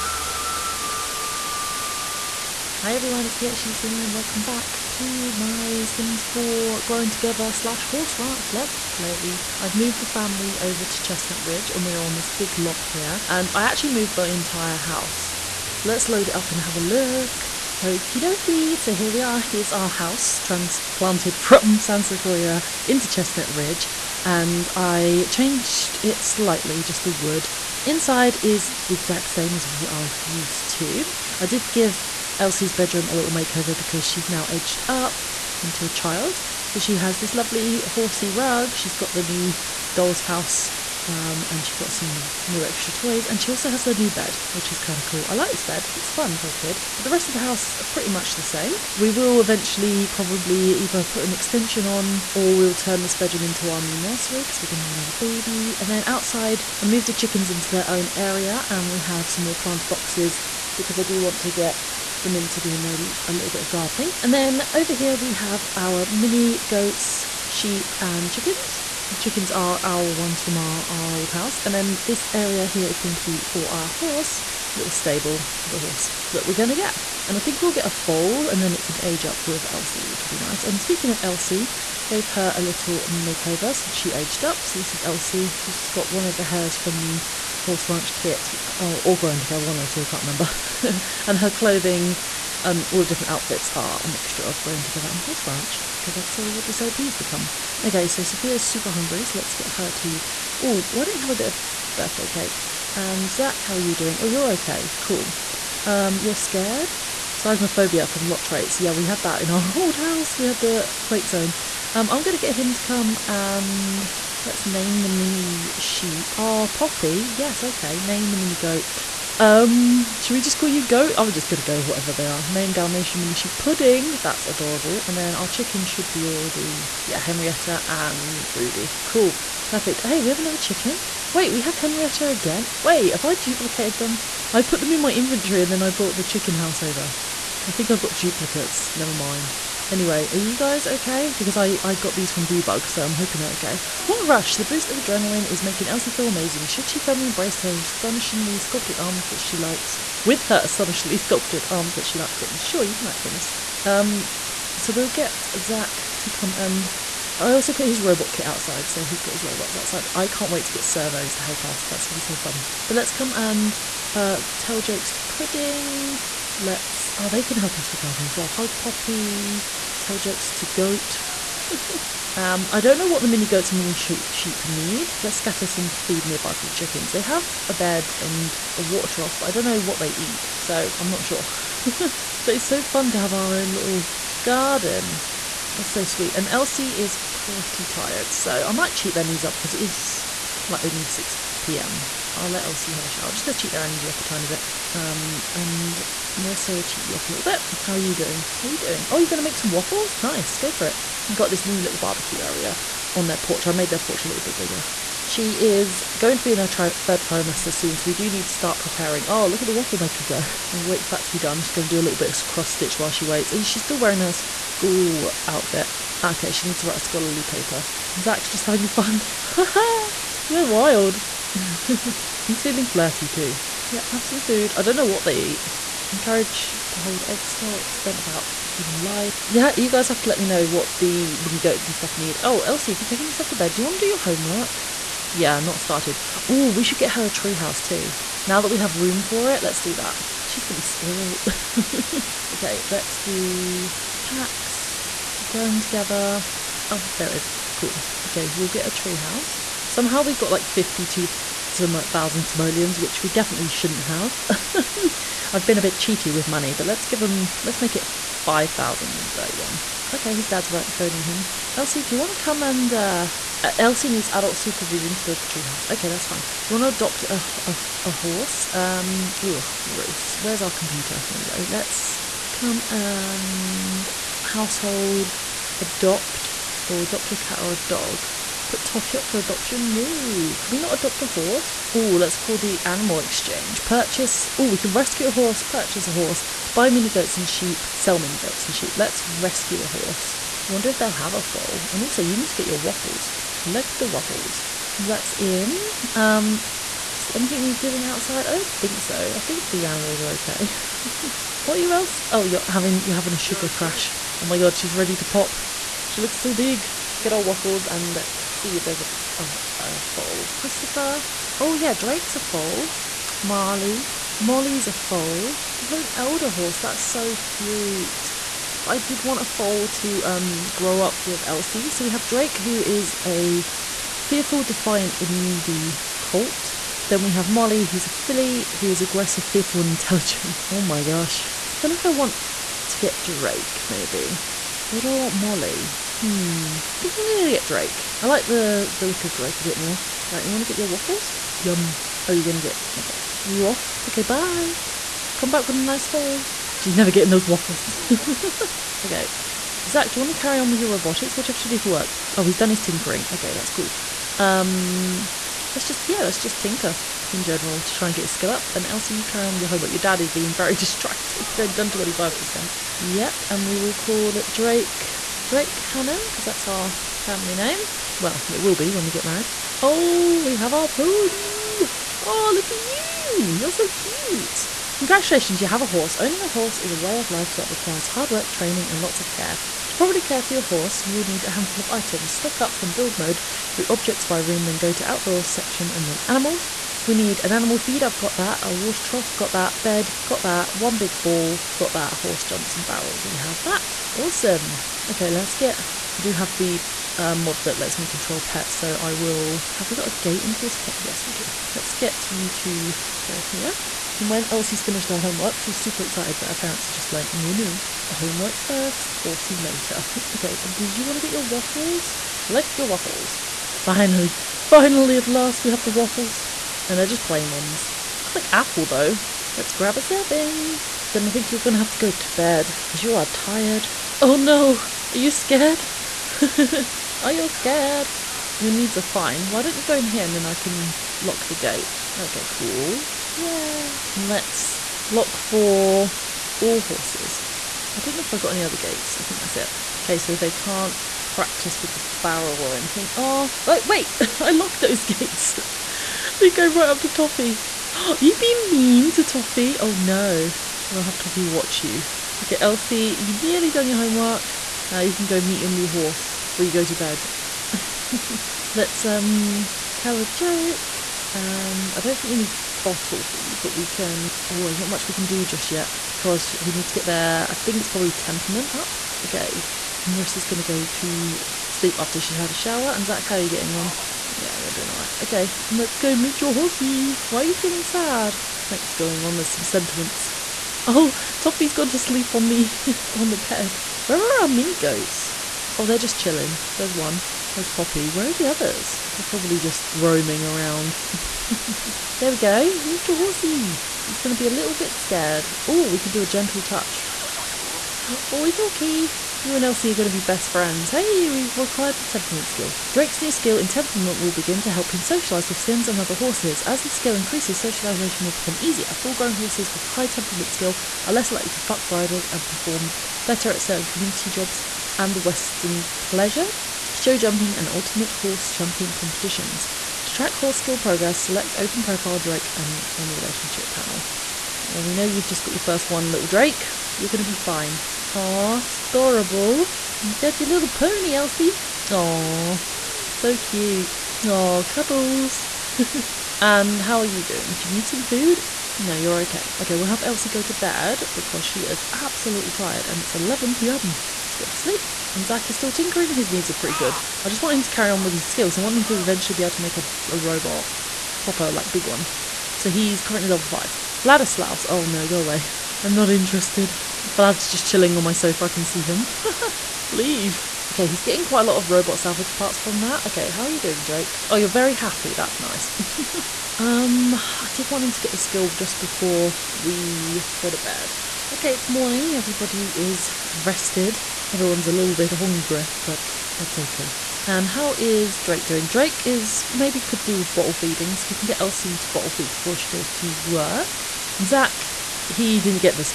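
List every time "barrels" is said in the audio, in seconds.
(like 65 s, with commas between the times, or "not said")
392 s, 442 s.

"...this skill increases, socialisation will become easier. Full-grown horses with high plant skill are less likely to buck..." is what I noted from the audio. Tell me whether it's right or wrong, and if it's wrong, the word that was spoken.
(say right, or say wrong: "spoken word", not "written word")
wrong: "temperament", not "plant".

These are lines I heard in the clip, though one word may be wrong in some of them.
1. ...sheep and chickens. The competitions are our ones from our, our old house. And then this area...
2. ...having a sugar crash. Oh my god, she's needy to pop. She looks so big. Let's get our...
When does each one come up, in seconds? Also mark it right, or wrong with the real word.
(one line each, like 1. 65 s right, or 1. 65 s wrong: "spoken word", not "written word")
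1. 67 s wrong: "chickens", not "competitions"
2. 303 s wrong: "ready", not "needy".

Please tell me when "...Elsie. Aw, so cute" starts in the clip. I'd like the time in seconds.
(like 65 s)
531 s.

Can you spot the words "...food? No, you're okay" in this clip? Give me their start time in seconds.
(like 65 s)
538 s.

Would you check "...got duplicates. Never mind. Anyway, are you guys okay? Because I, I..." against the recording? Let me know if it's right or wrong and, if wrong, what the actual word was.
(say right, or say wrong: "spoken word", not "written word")
right.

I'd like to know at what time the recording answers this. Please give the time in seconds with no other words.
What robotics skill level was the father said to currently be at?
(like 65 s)
553 s.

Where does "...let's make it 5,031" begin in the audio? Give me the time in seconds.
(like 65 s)
257 s.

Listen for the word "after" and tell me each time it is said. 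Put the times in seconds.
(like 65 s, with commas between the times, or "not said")
471 s.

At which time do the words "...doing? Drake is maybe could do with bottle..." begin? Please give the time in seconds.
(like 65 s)
578 s.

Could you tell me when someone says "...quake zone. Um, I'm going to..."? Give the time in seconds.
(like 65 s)
110 s.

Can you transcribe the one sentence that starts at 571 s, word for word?
Okay, it's morning, everybody is rested.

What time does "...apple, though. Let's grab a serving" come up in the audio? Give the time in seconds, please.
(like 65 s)
418 s.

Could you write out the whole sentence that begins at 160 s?
I can't wait to get servos to help us.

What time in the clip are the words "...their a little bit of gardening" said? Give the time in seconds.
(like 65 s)
62 s.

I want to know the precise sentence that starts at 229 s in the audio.
Yeah, you guys have to let me know what the mini goats and stuff need.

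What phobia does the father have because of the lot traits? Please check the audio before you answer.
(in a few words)
Seismophobia.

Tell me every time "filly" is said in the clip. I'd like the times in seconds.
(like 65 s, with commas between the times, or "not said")
328 s.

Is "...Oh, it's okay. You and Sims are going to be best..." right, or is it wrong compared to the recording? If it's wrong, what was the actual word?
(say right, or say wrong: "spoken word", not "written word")
wrong: "Elsie", not "Sims".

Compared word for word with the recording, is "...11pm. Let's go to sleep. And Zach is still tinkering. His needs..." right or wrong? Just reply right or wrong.
right.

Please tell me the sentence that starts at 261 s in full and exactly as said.
Elsie, do you want to come and, uh, uh, Elsie needs adult supervision to build the treehouse.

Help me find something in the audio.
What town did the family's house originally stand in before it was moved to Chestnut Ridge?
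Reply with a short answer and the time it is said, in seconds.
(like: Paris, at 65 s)
San Sequoia, at 21 s.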